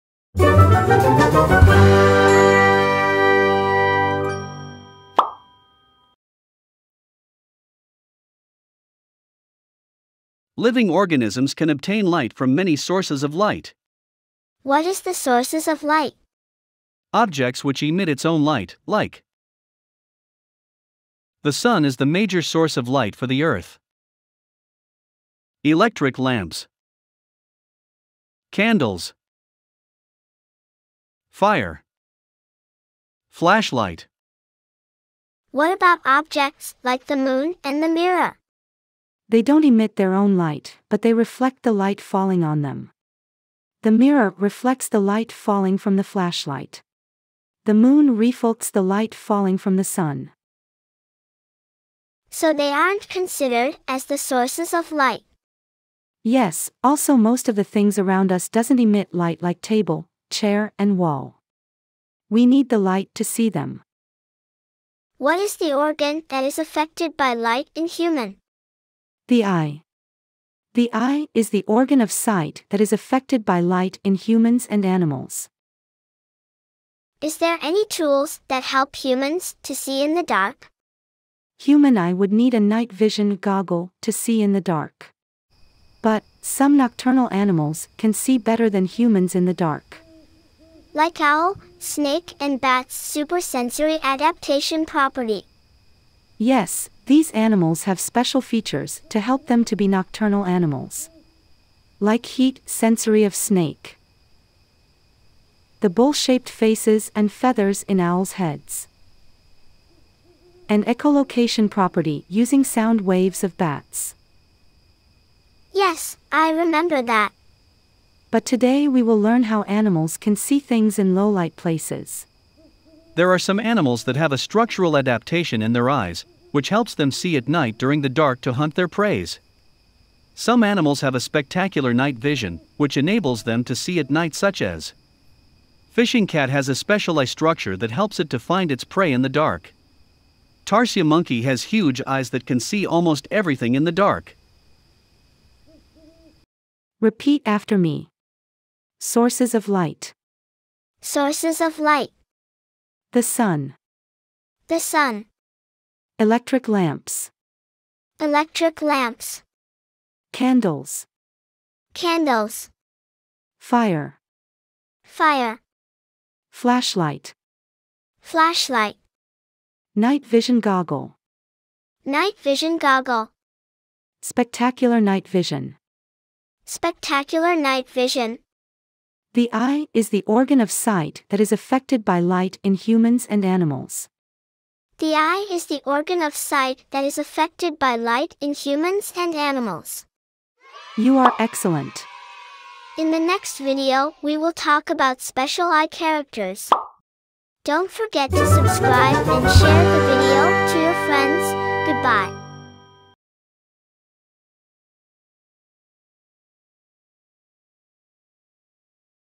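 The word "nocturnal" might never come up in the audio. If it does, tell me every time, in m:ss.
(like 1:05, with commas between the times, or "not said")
1:26, 1:39.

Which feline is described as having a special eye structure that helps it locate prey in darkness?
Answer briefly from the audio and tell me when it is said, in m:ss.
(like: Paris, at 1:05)
Fishing cat, at 2:15.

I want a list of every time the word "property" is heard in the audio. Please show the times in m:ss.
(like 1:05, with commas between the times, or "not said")
1:34, 1:51.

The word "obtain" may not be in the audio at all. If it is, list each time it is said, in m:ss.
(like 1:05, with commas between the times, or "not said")
0:11.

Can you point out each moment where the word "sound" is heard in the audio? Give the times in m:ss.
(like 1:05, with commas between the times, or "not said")
1:52.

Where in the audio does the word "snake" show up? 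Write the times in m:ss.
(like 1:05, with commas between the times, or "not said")
1:31, 1:43.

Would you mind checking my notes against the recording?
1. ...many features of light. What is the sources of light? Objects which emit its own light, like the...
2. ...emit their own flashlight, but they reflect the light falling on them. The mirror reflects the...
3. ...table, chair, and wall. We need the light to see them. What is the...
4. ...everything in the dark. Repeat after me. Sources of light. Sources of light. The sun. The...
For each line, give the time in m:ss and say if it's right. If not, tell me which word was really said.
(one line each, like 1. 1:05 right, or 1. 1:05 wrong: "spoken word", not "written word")
1. 0:12 wrong: "sources", not "features"
2. 0:39 wrong: "light", not "flashlight"
3. 0:59 right
4. 2:23 right.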